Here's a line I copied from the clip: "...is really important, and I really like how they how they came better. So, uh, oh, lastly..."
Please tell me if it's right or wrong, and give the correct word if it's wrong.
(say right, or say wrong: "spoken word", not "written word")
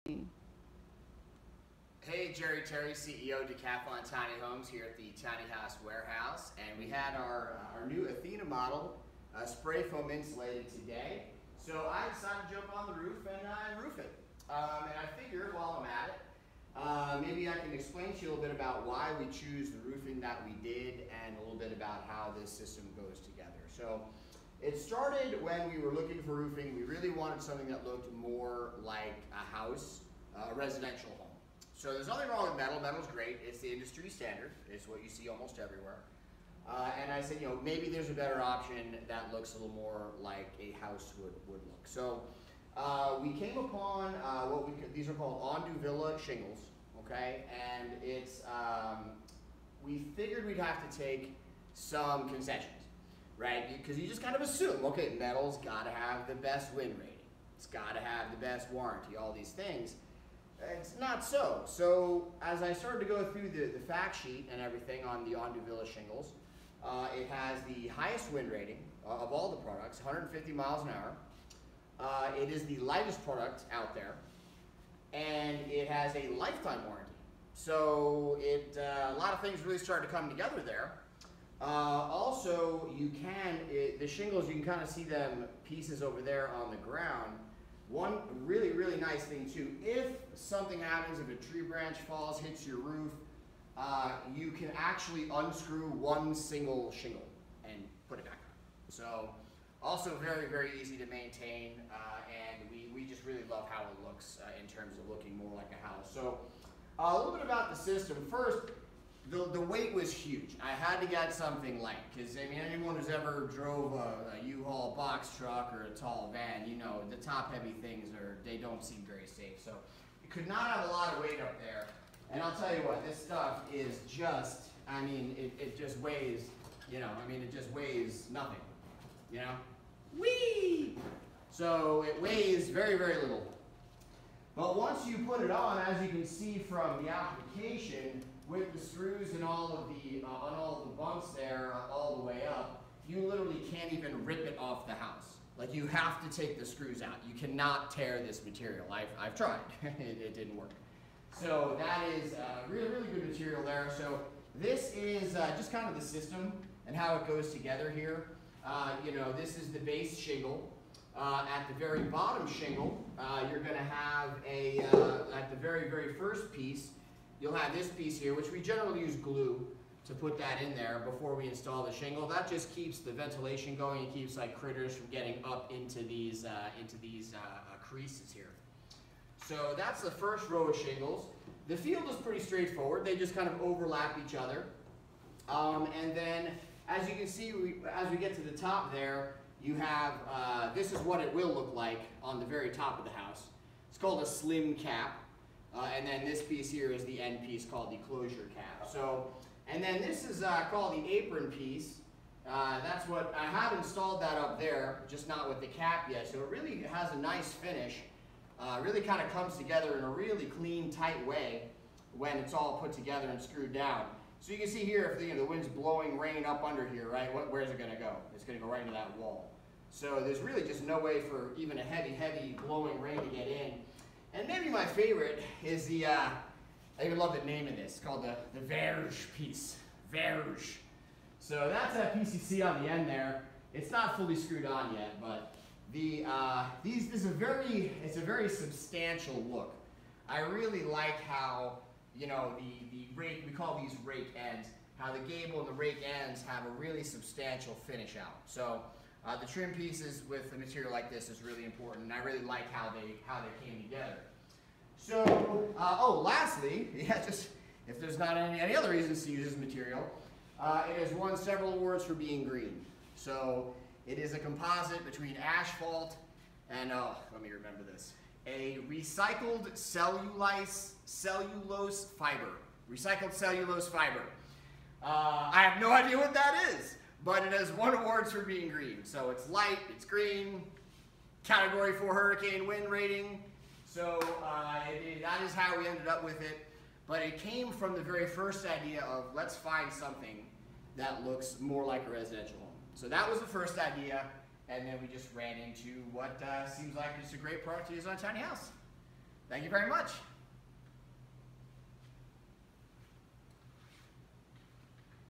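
wrong: "together", not "better".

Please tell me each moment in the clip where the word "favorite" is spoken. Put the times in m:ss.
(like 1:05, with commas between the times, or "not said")
3:44.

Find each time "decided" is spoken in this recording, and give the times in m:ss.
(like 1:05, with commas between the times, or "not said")
0:12.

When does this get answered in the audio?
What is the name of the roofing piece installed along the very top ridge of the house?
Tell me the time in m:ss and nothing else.
3:14.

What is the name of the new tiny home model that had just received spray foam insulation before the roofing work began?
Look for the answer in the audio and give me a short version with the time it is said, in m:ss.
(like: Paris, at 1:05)
Athena, at 0:08.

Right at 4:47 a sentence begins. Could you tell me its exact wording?
But it came from the very first idea of let's find something that looks more like a residential home.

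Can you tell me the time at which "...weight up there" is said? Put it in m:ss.
2:01.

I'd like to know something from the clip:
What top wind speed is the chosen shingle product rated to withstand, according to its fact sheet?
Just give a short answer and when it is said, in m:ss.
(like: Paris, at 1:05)
150 miles an hour, at 1:10.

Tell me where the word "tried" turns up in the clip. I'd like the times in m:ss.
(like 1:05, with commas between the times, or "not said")
2:29.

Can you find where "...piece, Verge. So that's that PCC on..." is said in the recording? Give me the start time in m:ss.
3:49.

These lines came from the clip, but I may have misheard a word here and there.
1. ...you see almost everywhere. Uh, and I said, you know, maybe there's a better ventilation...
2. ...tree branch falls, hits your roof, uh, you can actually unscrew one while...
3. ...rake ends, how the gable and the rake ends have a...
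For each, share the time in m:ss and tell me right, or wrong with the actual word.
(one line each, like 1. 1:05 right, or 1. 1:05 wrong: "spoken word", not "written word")
1. 0:35 wrong: "option", not "ventilation"
2. 1:31 wrong: "single", not "while"
3. 4:04 right.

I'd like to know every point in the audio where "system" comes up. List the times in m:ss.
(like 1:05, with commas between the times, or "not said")
0:22, 1:47, 2:36.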